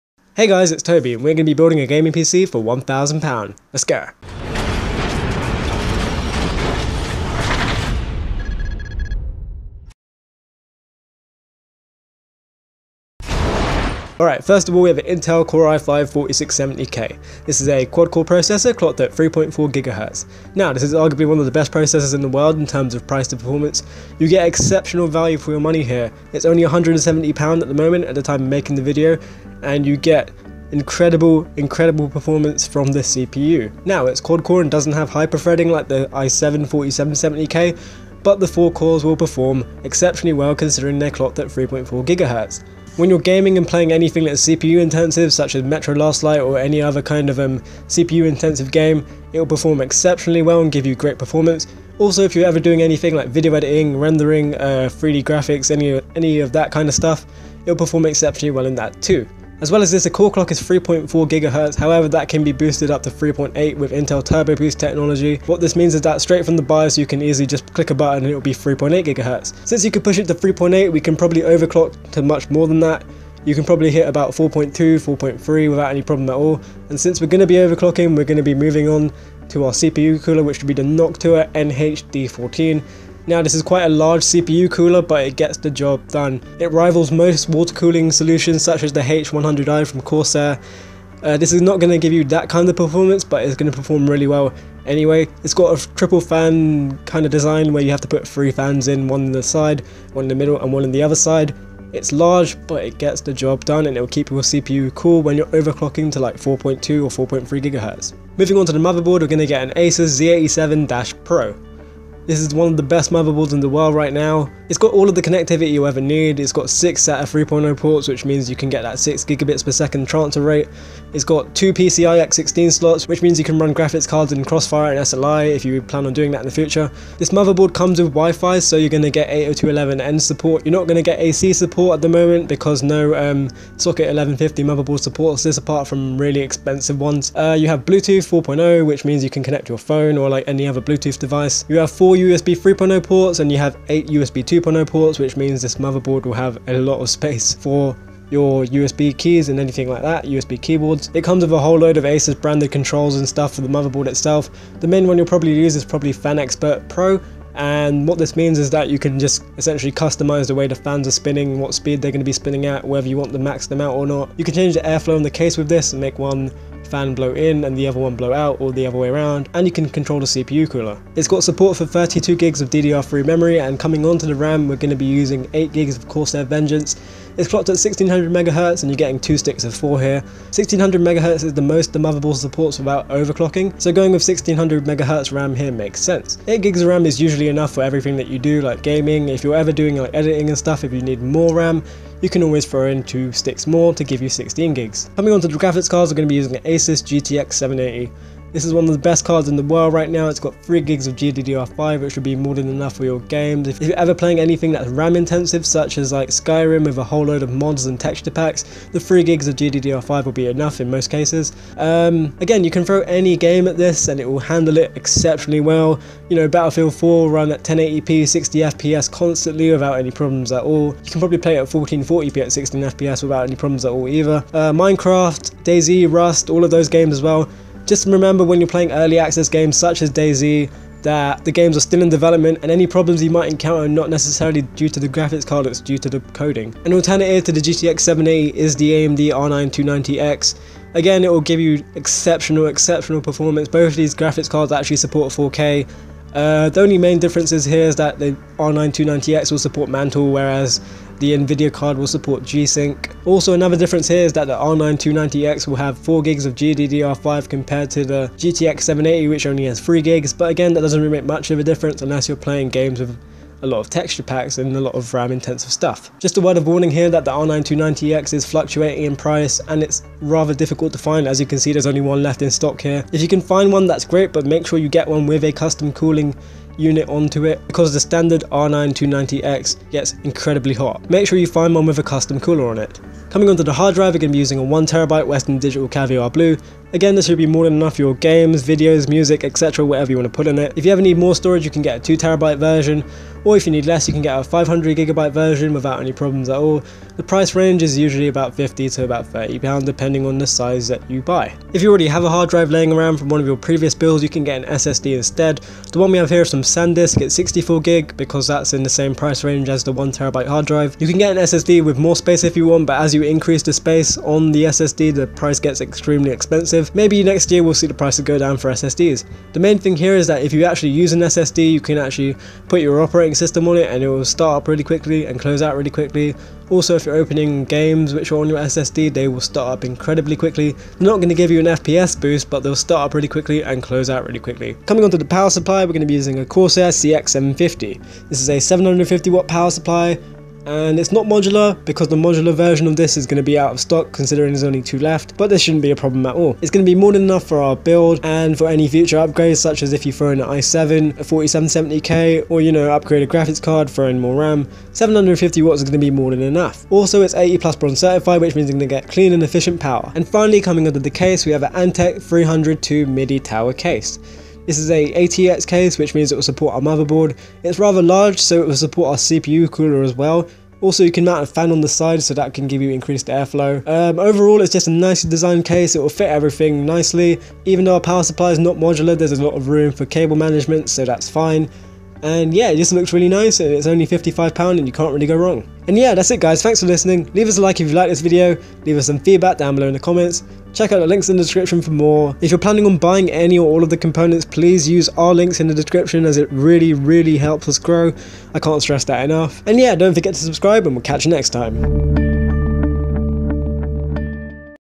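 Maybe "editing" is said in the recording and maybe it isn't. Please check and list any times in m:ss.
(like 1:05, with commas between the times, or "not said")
0:53, 3:10.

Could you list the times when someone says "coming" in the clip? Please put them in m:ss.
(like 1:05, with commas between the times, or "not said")
2:53, 3:15, 4:43, 5:34, 6:00.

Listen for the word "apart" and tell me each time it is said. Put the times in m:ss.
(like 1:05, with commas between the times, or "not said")
2:15.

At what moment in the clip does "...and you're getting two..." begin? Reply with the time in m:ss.
2:58.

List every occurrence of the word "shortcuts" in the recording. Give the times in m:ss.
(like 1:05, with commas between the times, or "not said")
not said.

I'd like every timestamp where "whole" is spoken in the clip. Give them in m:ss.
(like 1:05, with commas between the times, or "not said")
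2:31, 3:27.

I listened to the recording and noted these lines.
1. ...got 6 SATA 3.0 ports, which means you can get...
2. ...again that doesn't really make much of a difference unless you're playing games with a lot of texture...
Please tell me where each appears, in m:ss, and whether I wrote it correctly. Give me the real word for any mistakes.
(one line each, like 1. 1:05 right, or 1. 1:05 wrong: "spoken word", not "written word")
1. 1:56 right
2. 4:20 right.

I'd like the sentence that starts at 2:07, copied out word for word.
This motherboard comes with Wi-Fi, so you're going to get 802.11n support.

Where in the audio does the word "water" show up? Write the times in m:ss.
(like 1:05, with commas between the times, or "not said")
1:27.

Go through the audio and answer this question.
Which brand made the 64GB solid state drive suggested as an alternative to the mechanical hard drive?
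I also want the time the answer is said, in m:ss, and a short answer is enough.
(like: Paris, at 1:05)
SanDisk, at 5:06.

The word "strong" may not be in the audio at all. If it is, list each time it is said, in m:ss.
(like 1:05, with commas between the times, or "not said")
not said.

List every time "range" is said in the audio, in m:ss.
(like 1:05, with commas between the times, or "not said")
4:57, 5:09.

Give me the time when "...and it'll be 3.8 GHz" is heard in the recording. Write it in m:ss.
1:08.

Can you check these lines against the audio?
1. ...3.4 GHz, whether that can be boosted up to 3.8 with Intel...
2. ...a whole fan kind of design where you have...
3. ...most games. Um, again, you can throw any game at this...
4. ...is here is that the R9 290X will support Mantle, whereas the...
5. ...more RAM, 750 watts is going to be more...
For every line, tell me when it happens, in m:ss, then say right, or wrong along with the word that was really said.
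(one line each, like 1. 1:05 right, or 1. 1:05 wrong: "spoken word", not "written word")
1. 1:00 wrong: "however", not "whether"
2. 1:35 wrong: "triple", not "whole"
3. 3:30 wrong: "cases", not "games"
4. 4:07 right
5. 5:54 right.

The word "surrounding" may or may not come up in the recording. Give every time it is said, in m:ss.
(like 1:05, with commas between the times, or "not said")
not said.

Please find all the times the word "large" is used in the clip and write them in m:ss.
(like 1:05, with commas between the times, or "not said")
1:23, 1:42, 6:08.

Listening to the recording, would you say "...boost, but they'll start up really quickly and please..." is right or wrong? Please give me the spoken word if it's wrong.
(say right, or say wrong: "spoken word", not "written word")
wrong: "close", not "please".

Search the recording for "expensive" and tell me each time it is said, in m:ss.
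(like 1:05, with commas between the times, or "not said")
2:16, 5:16.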